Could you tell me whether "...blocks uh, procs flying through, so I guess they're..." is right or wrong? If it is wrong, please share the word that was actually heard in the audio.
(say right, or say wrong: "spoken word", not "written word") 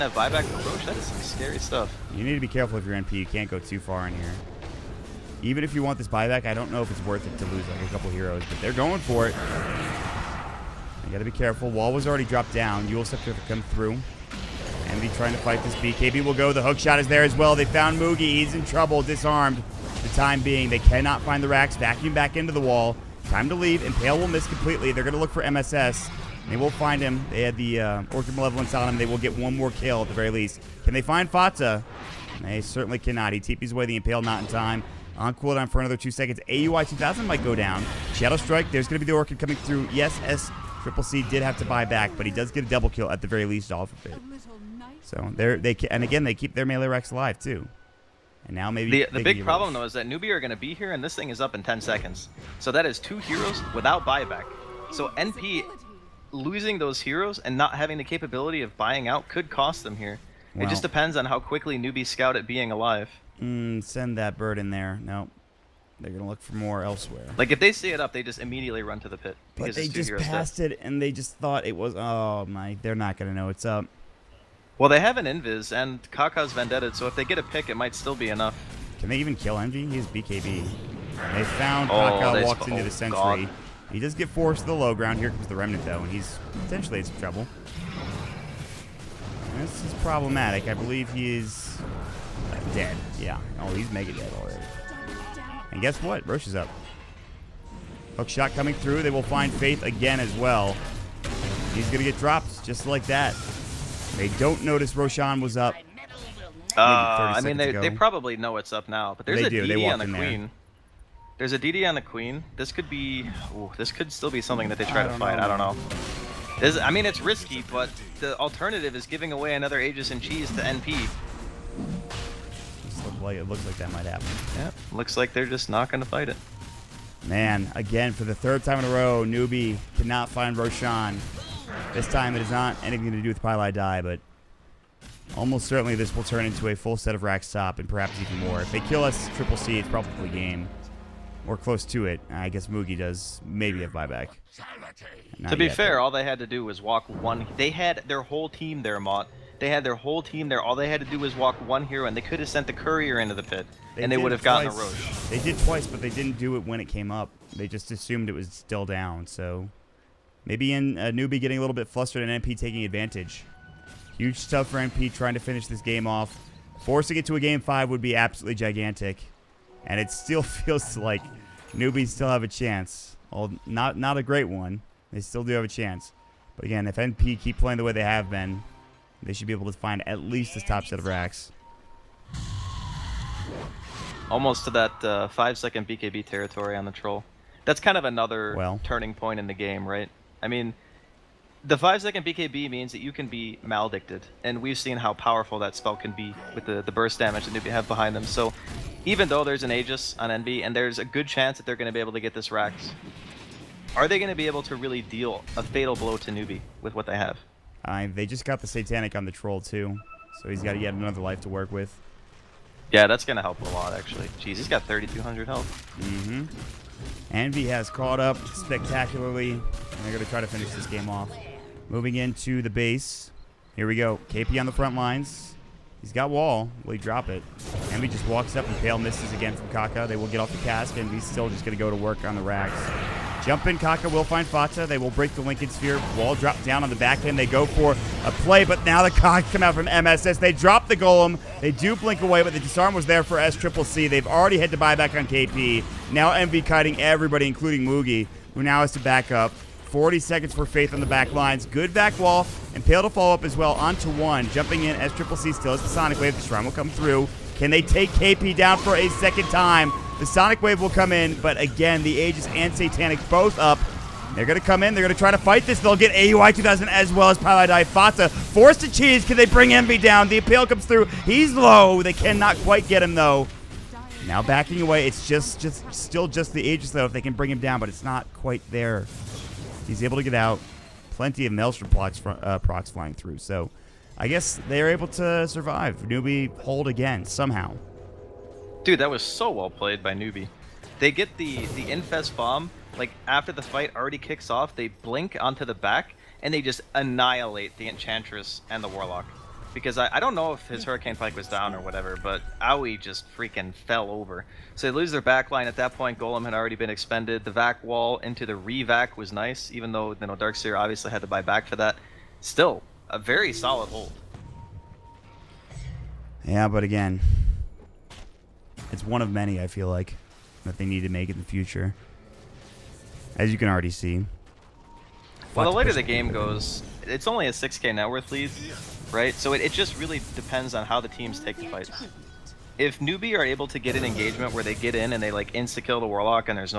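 right.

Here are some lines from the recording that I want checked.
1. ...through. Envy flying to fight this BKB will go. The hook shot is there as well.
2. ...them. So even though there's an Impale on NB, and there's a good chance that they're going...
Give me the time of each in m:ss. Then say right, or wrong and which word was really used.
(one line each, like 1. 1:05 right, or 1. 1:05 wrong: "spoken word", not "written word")
1. 0:13 wrong: "trying", not "flying"
2. 3:18 wrong: "Aegis", not "Impale".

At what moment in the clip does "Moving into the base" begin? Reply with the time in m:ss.
3:41.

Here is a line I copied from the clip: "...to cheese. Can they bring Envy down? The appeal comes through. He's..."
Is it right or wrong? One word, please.
right.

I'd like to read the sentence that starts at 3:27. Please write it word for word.
Uh, they just got the Satanic on the troll too, so he's got yet another life to work with.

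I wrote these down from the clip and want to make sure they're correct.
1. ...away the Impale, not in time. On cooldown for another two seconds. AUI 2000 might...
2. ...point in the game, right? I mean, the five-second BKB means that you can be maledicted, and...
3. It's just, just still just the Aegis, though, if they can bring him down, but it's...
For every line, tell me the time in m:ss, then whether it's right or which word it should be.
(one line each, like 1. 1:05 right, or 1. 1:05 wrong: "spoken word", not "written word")
1. 0:33 right
2. 3:09 right
3. 4:35 right.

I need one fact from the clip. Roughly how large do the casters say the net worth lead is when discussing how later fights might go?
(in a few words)
6k.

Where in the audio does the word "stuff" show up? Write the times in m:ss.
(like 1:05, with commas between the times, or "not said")
0:01, 2:44.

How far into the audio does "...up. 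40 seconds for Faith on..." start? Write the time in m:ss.
4:09.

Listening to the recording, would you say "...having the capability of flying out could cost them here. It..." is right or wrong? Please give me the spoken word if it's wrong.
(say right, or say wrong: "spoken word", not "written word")
wrong: "buying", not "flying".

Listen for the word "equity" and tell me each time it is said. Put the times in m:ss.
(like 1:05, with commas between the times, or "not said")
not said.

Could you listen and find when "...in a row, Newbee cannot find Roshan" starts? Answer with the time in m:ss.
2:08.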